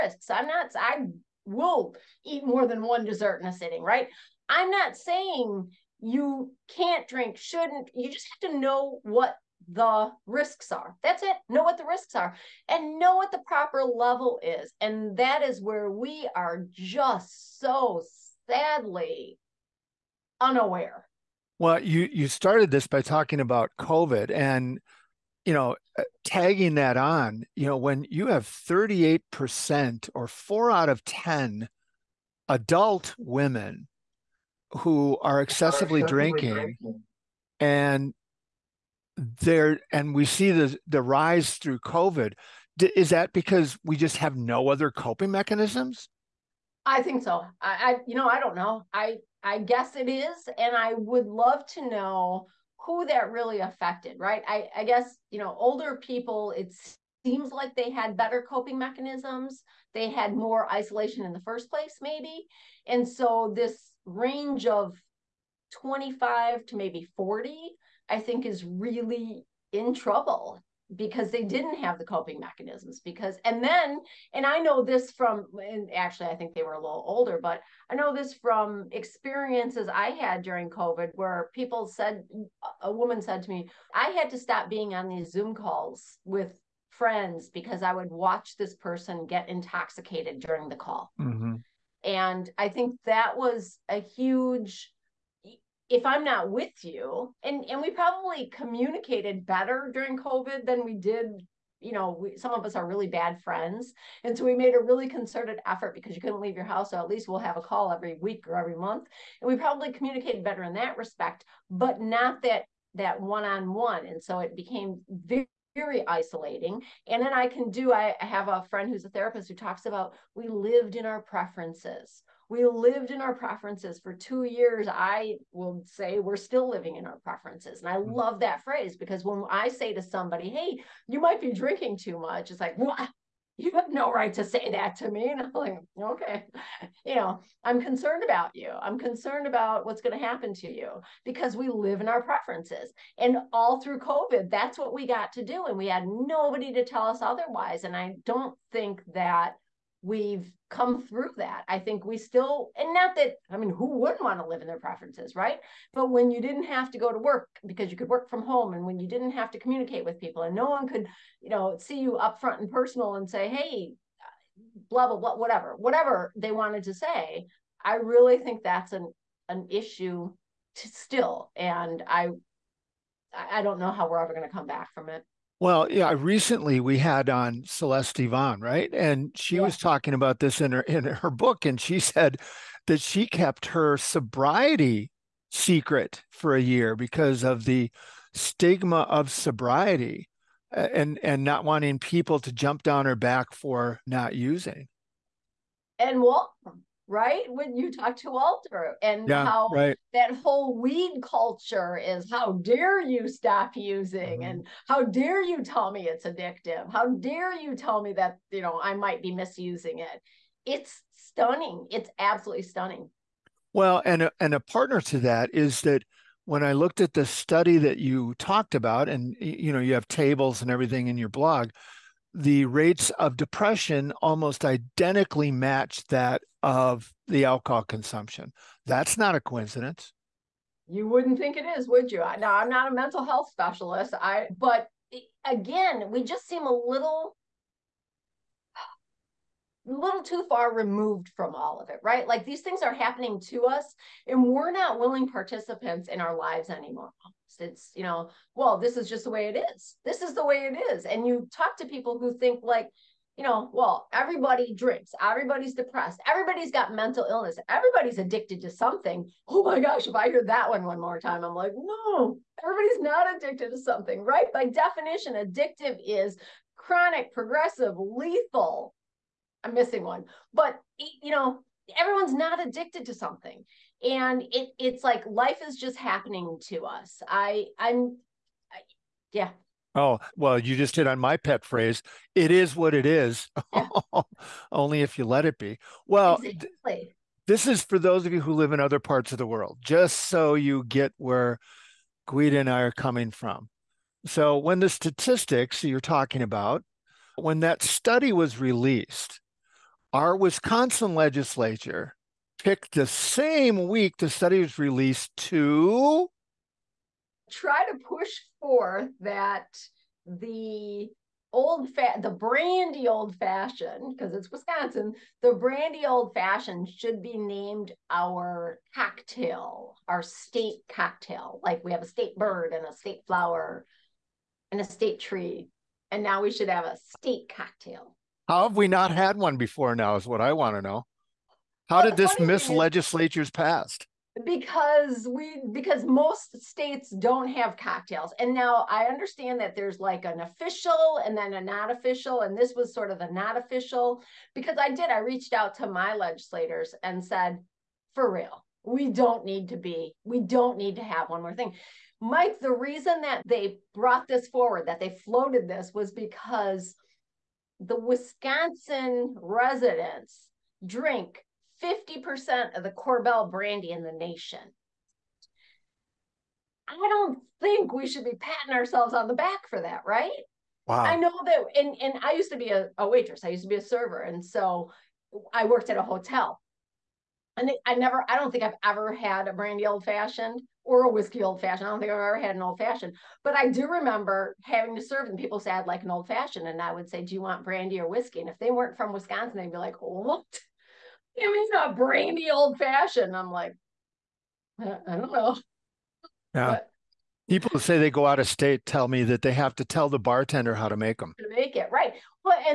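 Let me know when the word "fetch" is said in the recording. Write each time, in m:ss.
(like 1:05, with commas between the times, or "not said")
not said.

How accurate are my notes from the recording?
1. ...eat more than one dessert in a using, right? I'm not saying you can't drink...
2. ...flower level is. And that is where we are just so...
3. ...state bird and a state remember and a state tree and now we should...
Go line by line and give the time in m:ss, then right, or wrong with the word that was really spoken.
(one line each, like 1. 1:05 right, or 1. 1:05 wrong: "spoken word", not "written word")
1. 0:02 wrong: "sitting", not "using"
2. 0:13 wrong: "proper", not "flower"
3. 5:22 wrong: "flower", not "remember".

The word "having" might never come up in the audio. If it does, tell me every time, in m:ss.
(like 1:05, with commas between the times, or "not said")
6:24.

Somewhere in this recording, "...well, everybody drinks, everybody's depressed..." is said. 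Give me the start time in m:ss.
4:13.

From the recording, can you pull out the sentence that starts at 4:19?
Oh my gosh, if I hear that one one more time, I'm like, no, everybody's not addicted to something, right?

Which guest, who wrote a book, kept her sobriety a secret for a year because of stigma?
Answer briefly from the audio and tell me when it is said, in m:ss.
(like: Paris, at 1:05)
Celeste Yvonne, at 2:57.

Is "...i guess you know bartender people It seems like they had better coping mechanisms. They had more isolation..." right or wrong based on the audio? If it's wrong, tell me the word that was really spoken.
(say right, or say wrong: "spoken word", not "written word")
wrong: "older", not "bartender".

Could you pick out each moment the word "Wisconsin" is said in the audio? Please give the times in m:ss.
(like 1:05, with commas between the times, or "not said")
5:00, 5:14, 5:57, 6:29.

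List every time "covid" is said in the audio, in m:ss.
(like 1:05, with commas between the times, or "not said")
0:23, 0:41, 1:20, 1:40, 2:23.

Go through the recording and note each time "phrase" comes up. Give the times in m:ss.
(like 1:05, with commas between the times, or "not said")
2:08, 4:41.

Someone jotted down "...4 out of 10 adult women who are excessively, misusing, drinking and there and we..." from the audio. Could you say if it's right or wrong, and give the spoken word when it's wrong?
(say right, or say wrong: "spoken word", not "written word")
wrong: "drinking", not "misusing".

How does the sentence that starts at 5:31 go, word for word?
How well, did this miss legislatures passed?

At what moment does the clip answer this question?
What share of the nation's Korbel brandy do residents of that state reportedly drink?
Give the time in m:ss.
6:01.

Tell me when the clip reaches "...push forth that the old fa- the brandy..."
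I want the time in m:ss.
5:07.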